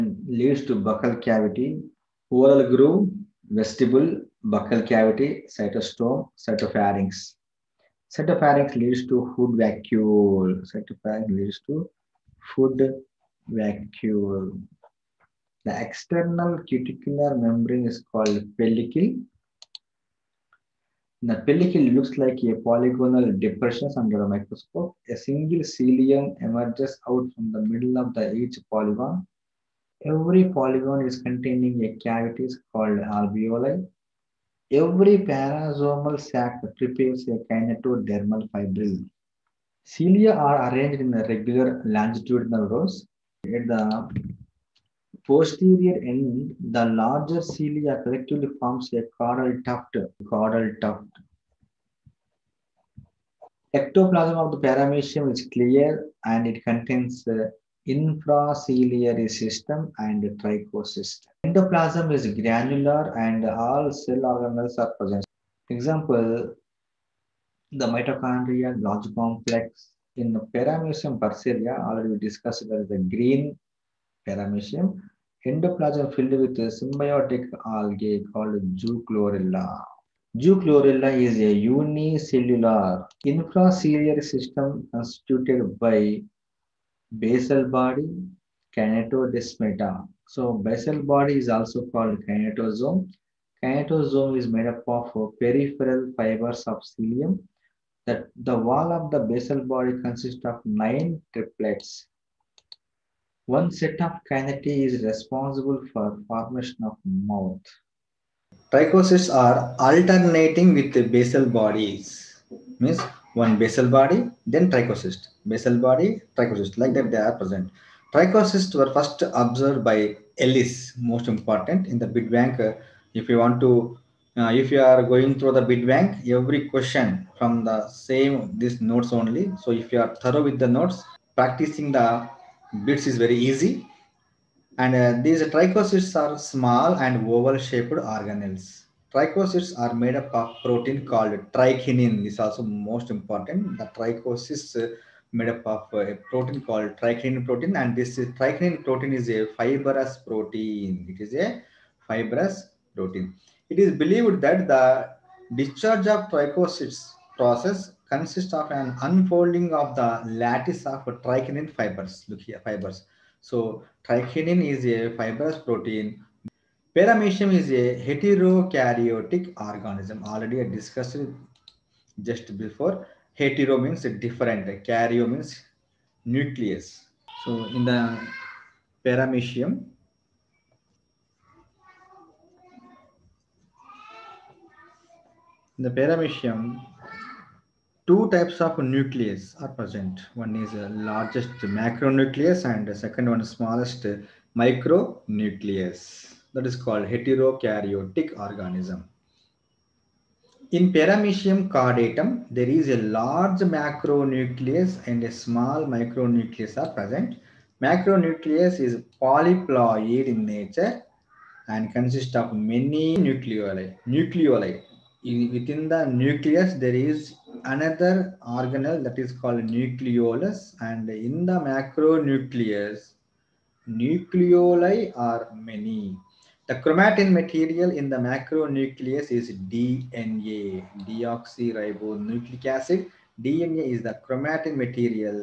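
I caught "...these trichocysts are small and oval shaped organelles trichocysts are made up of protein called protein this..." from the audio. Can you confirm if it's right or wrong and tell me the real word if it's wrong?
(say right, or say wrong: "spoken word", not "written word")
wrong: "trichynin", not "protein".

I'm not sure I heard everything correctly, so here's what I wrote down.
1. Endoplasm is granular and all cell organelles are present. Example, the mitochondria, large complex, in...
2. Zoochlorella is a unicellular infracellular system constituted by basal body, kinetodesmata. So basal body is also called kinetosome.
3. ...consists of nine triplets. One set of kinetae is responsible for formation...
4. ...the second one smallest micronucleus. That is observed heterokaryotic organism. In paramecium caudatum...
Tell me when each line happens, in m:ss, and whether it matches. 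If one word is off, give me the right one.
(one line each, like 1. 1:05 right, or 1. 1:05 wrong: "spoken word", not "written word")
1. 1:01 right
2. 1:20 right
3. 1:40 right
4. 3:12 wrong: "called", not "observed".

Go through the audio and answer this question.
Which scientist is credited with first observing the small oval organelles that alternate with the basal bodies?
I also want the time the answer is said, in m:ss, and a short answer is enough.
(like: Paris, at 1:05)
Ellis, at 2:00.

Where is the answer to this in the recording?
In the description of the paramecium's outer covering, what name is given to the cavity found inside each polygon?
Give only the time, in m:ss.
0:32.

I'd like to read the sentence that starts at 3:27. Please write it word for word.
Macronucleus is polyploid in nature and consists of many nucleoli.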